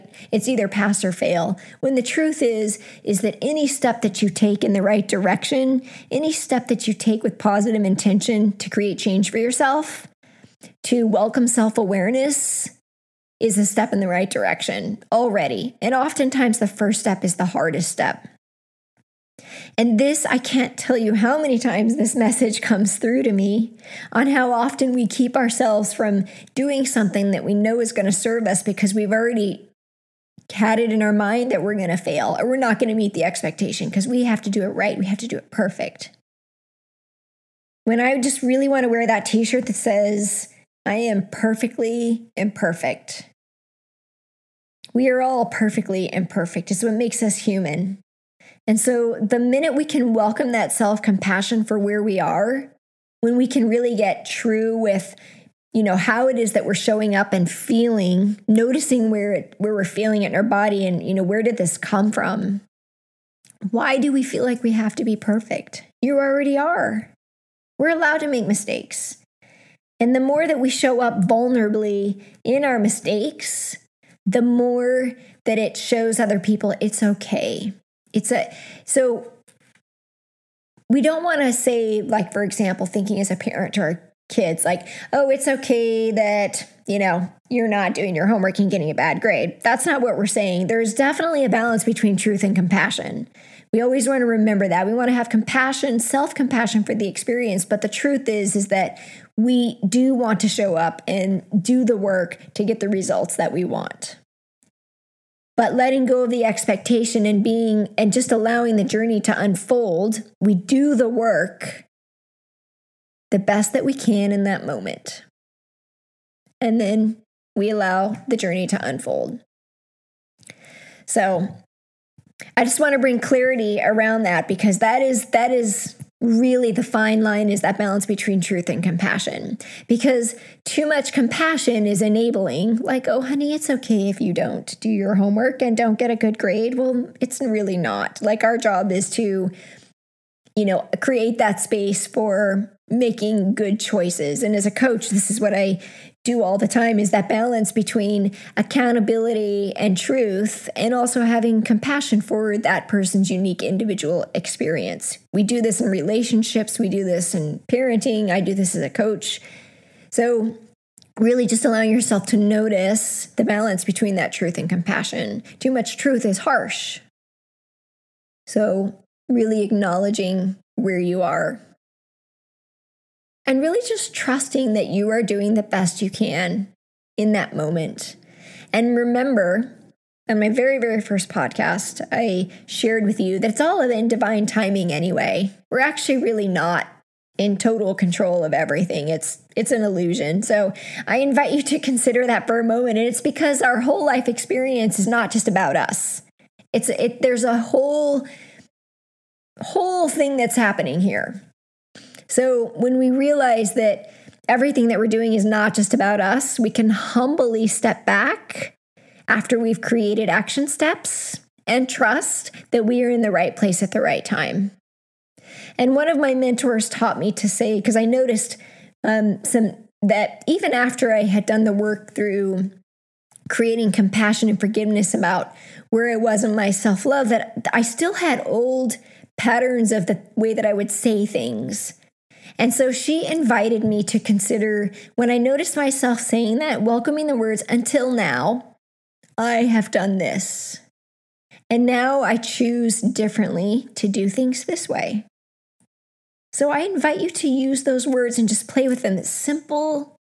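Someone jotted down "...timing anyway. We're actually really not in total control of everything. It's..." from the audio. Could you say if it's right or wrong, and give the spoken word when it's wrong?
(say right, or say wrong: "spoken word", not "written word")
right.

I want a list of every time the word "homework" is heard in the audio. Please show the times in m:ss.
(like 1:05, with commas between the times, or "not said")
1:28, 2:15.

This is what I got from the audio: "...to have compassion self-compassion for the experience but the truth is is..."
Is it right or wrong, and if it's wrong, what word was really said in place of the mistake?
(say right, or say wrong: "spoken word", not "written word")
right.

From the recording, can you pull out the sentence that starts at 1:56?
And then we allow the journey to unfold.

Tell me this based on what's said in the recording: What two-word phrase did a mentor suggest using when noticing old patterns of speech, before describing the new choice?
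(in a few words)
Until now.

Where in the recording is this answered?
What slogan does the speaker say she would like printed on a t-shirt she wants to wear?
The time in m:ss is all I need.
0:40.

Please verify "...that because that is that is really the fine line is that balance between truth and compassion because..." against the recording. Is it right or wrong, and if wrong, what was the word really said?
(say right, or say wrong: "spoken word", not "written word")
right.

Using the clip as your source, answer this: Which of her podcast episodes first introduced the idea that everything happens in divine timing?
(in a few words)
Very first podcast.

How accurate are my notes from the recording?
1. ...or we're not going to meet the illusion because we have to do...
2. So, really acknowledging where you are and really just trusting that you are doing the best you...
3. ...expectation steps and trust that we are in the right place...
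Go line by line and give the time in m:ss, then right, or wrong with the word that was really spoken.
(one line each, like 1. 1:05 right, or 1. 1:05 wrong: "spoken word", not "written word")
1. 0:32 wrong: "expectation", not "illusion"
2. 2:48 right
3. 3:30 wrong: "action", not "expectation".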